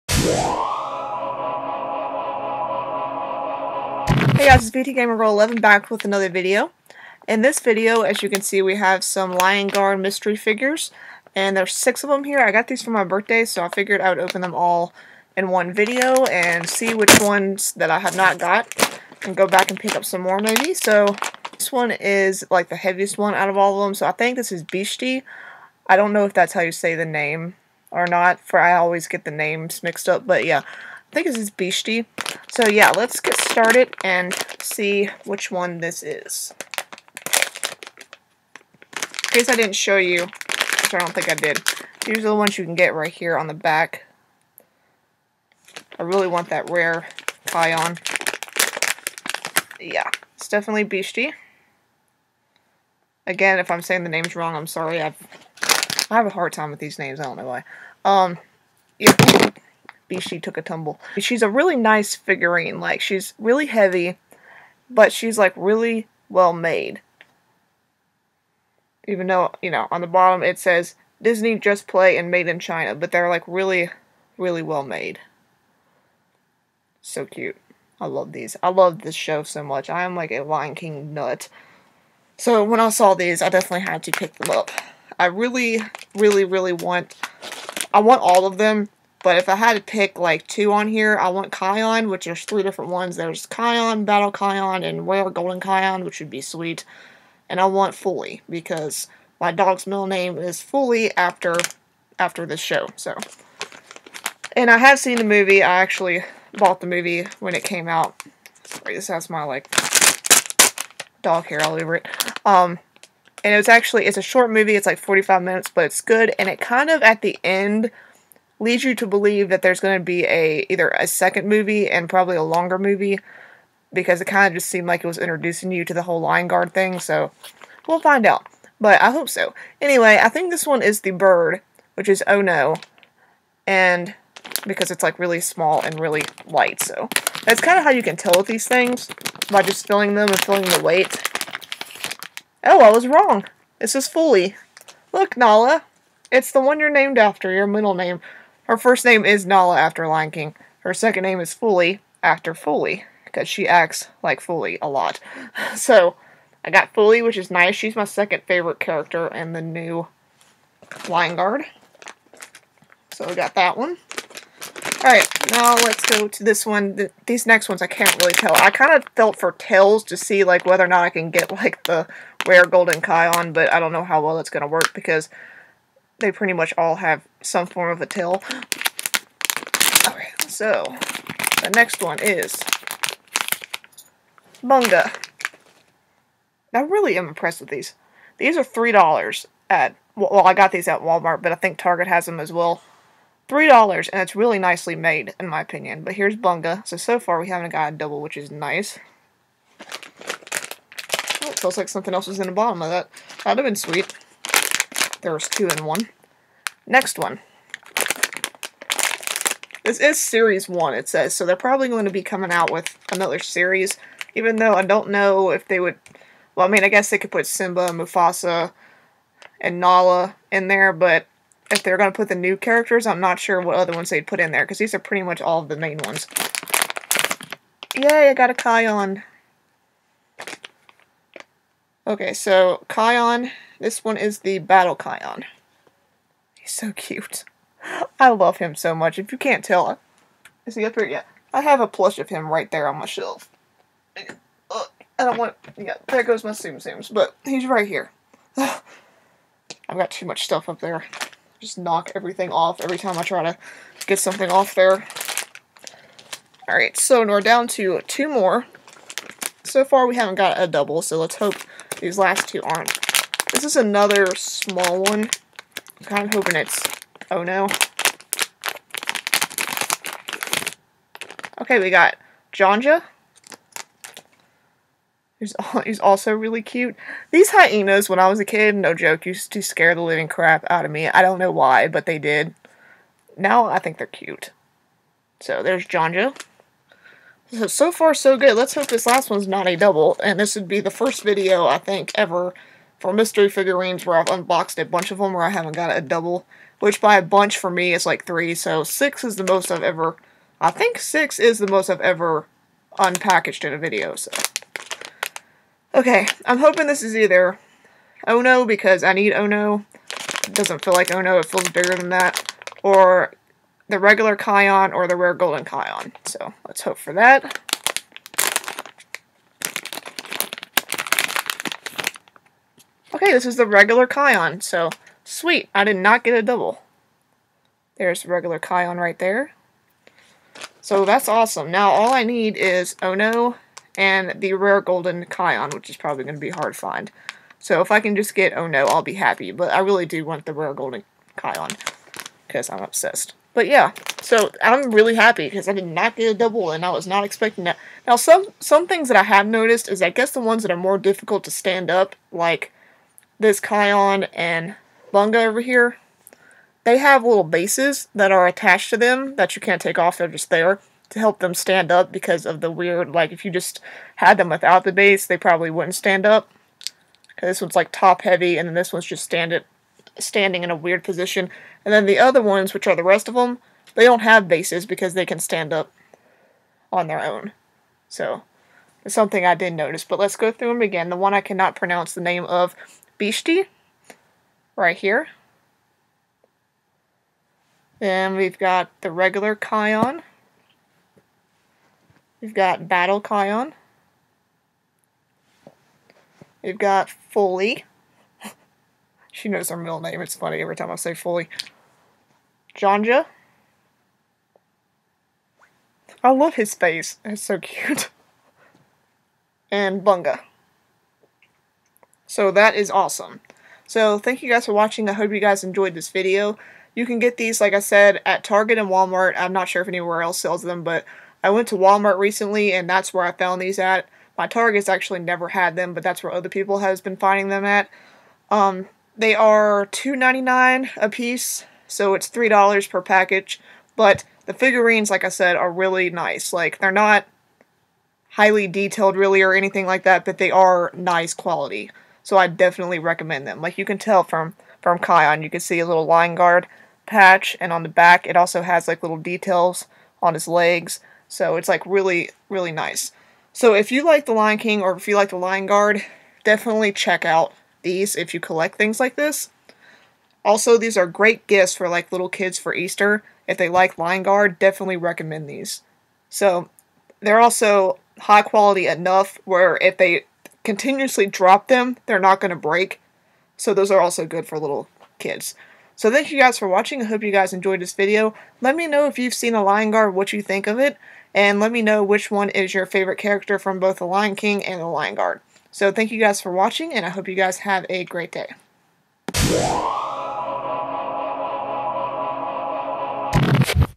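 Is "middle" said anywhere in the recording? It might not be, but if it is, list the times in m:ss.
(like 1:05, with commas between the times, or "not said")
1:39, 2:27, 6:39.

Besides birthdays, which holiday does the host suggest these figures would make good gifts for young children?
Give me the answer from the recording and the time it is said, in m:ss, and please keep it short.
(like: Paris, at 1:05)
Easter, at 7:42.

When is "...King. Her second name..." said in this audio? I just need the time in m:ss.
2:30.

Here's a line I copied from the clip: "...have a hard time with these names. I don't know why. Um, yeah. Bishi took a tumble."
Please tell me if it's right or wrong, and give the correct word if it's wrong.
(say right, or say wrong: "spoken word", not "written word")
right.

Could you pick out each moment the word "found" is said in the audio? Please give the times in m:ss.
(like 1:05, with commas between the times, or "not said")
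7:03.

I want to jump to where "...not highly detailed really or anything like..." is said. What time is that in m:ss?
7:16.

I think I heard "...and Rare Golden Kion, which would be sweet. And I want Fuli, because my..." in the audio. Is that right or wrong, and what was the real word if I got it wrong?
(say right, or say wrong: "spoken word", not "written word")
right.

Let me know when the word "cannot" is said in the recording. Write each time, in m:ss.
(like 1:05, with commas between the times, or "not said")
6:21.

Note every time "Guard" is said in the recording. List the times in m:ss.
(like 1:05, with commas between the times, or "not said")
0:09, 2:06, 2:41, 7:26, 7:35, 7:44, 7:59, 8:05.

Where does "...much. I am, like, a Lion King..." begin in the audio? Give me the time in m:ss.
1:19.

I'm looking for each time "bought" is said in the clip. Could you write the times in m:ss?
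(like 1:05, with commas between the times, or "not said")
1:46.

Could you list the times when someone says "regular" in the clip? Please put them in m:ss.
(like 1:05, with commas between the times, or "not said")
5:13, 5:23, 5:28, 6:29.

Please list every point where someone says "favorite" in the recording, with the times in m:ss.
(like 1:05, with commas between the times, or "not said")
2:38, 8:02.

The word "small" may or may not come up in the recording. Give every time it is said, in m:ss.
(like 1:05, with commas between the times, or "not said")
2:15, 4:24.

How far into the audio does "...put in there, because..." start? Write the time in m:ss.
3:44.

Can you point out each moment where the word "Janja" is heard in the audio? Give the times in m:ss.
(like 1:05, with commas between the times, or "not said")
4:32, 4:45, 6:42.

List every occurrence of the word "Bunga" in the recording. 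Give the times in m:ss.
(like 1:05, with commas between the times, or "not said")
3:04, 3:16, 5:55, 6:50.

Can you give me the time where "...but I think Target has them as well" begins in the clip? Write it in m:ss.
3:11.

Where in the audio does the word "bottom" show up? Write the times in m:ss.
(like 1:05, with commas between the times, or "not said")
1:10, 3:22.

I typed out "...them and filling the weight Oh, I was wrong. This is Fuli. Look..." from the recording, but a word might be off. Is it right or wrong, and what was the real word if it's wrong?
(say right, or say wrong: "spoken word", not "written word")
right.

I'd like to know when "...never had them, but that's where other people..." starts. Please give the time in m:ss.
7:05.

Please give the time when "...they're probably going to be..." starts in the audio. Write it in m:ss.
3:31.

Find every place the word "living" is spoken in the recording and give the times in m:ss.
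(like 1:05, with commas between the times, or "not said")
4:40.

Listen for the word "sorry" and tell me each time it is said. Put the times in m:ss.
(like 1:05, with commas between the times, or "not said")
0:54, 1:48.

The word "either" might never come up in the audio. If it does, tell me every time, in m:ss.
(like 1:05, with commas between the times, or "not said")
2:00, 5:07.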